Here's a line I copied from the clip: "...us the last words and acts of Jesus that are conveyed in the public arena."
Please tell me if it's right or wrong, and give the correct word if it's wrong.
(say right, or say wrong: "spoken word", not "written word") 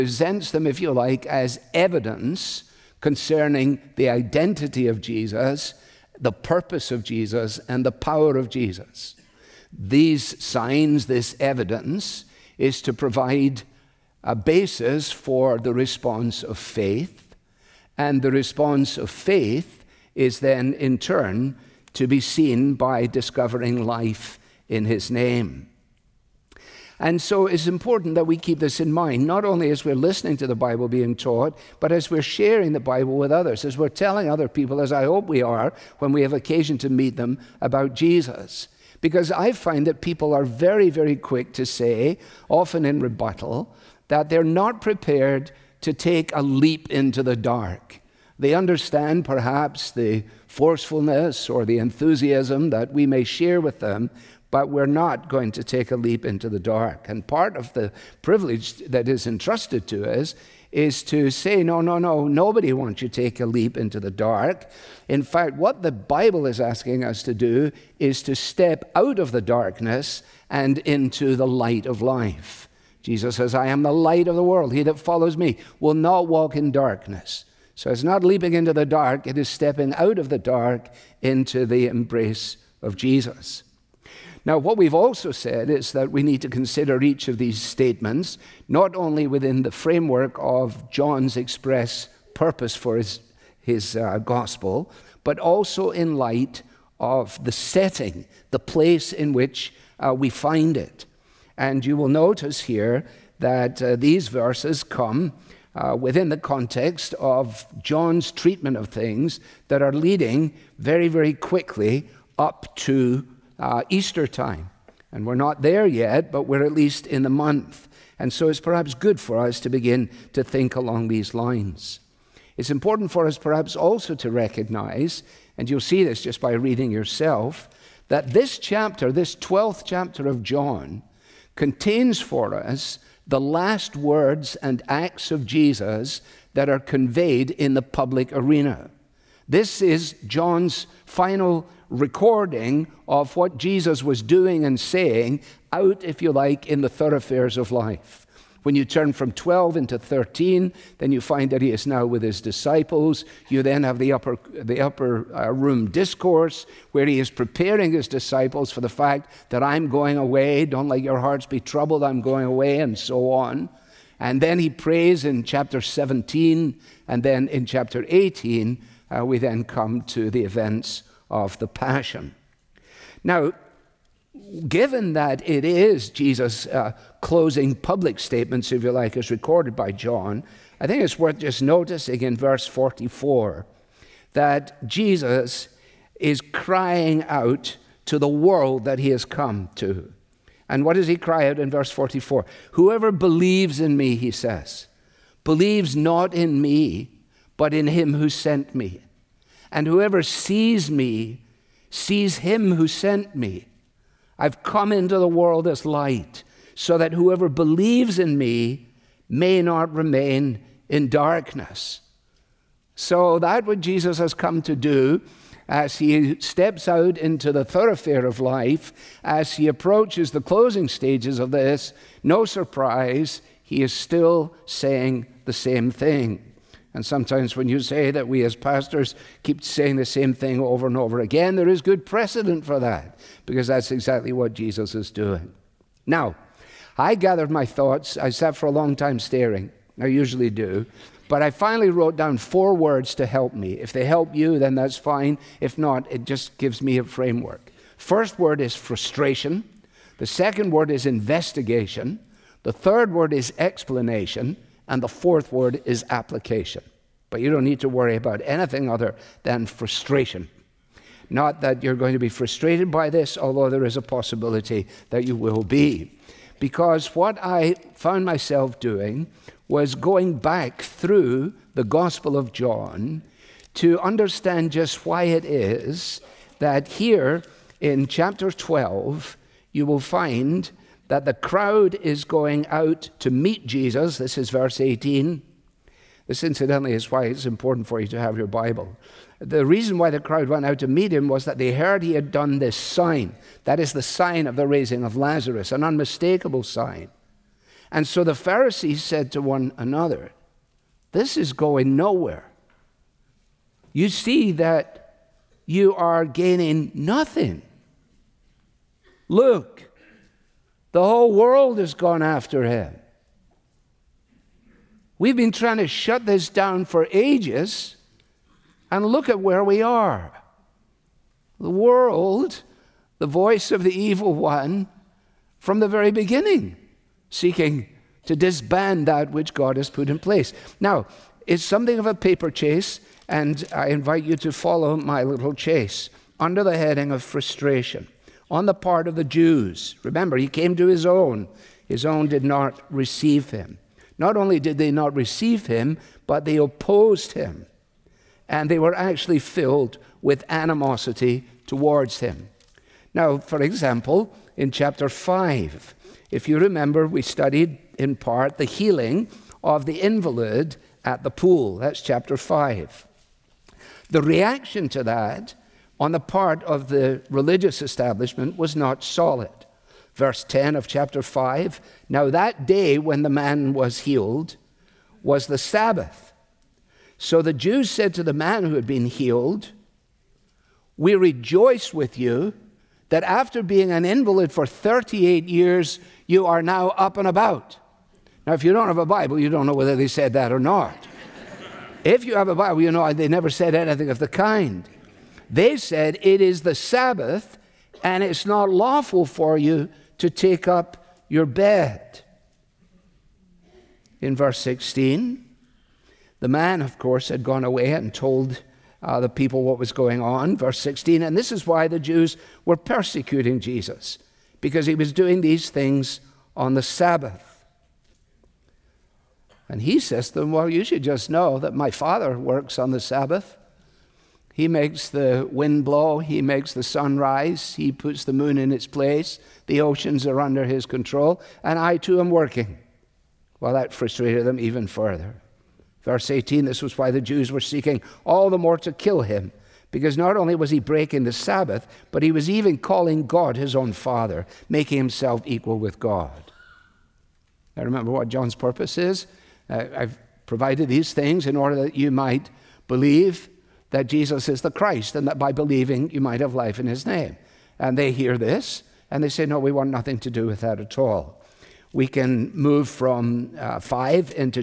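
right.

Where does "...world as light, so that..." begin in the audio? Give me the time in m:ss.
3:25.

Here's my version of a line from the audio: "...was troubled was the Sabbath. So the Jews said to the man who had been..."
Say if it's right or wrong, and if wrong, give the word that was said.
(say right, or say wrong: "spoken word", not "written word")
wrong: "healed", not "troubled".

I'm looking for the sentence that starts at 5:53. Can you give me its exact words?
Now, for example, in chapter 5, if you remember, we studied in part the healing of the invalid at the pool.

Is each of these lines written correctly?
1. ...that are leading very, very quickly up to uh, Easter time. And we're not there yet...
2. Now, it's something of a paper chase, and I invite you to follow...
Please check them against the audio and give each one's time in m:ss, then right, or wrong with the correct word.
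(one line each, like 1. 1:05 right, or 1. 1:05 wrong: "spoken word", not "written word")
1. 1:49 right
2. 5:30 right.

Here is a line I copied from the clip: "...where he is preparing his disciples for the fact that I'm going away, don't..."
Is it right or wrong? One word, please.
right.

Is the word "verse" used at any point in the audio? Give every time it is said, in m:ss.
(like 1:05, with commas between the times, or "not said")
1:44, 3:02, 3:11, 4:44, 6:10, 6:44, 6:50, 7:16.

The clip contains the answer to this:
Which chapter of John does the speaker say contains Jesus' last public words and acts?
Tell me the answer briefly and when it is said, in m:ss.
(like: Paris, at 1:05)
12th chapter, at 2:09.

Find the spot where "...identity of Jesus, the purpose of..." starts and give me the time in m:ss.
0:04.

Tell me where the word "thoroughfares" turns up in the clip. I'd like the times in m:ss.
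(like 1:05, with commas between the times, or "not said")
2:26, 3:37.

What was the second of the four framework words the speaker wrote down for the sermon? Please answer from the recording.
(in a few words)
Investigation.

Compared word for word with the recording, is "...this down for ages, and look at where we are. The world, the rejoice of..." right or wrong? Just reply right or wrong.
wrong.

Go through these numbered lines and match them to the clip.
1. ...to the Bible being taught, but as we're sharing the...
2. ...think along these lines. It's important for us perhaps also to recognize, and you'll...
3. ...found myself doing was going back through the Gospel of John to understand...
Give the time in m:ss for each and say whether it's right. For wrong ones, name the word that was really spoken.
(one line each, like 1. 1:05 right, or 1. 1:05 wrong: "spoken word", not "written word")
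1. 0:30 right
2. 2:00 right
3. 4:27 right.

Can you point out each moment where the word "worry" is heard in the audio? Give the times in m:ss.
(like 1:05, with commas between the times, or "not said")
4:17.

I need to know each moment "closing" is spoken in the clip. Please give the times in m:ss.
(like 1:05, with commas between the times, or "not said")
2:57, 3:40.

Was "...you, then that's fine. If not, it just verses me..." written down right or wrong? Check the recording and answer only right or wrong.
wrong.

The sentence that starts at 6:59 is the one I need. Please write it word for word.
And he says to them, Well, you should just know that my Father works on the Sabbath.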